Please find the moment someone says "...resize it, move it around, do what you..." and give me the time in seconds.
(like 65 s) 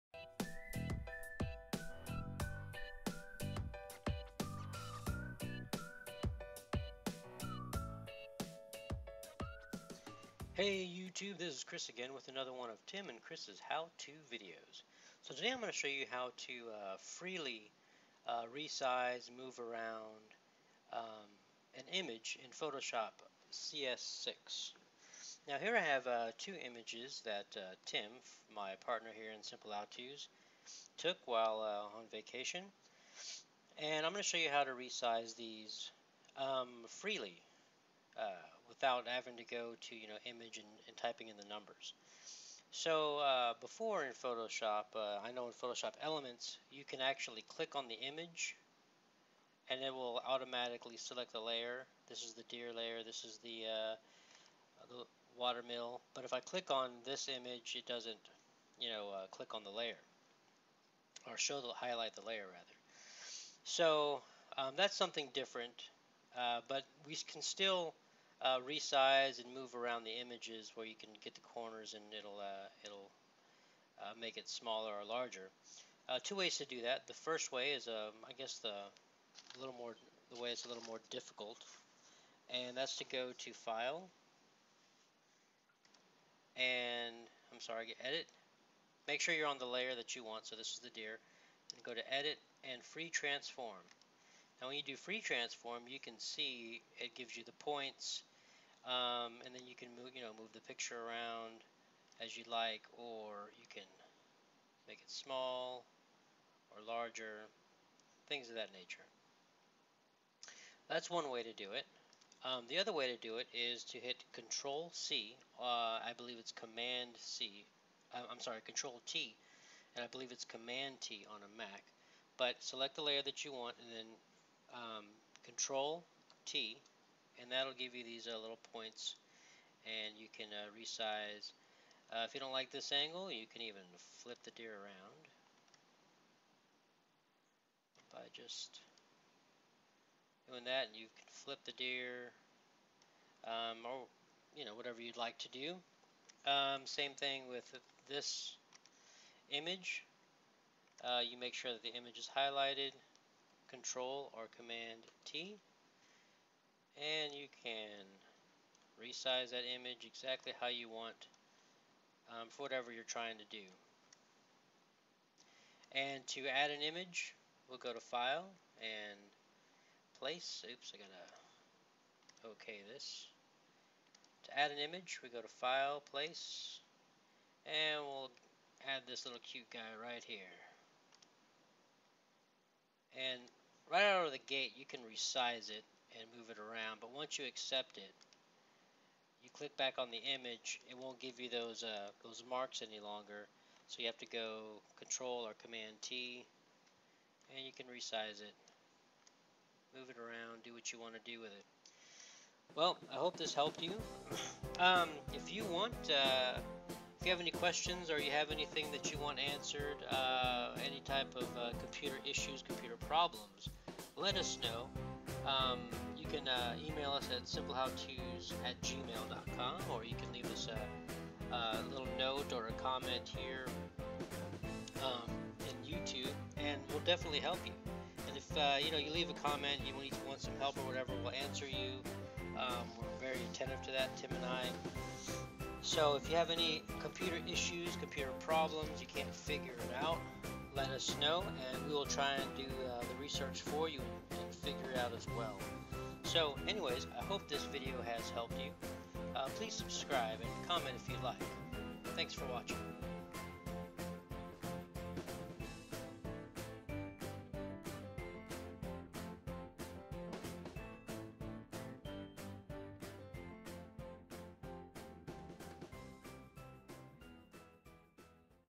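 197 s.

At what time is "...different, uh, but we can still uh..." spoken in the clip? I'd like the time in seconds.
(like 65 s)
65 s.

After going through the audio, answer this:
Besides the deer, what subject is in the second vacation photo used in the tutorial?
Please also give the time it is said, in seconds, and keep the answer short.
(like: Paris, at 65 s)
watermill, at 55 s.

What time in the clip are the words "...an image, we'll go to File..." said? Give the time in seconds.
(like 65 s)
166 s.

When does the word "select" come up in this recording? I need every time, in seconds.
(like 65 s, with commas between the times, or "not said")
50 s, 122 s.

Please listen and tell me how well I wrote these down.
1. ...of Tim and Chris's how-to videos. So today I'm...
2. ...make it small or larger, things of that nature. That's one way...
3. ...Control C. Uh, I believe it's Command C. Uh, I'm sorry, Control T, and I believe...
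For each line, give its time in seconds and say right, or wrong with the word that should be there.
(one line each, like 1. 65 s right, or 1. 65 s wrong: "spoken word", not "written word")
1. 12 s right
2. 104 s right
3. 114 s right.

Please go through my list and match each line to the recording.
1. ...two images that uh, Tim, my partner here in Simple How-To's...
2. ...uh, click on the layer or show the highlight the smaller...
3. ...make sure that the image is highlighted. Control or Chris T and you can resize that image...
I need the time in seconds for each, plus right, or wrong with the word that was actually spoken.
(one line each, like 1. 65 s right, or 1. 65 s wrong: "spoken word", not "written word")
1. 26 s right
2. 59 s wrong: "layer", not "smaller"
3. 151 s wrong: "Command", not "Chris".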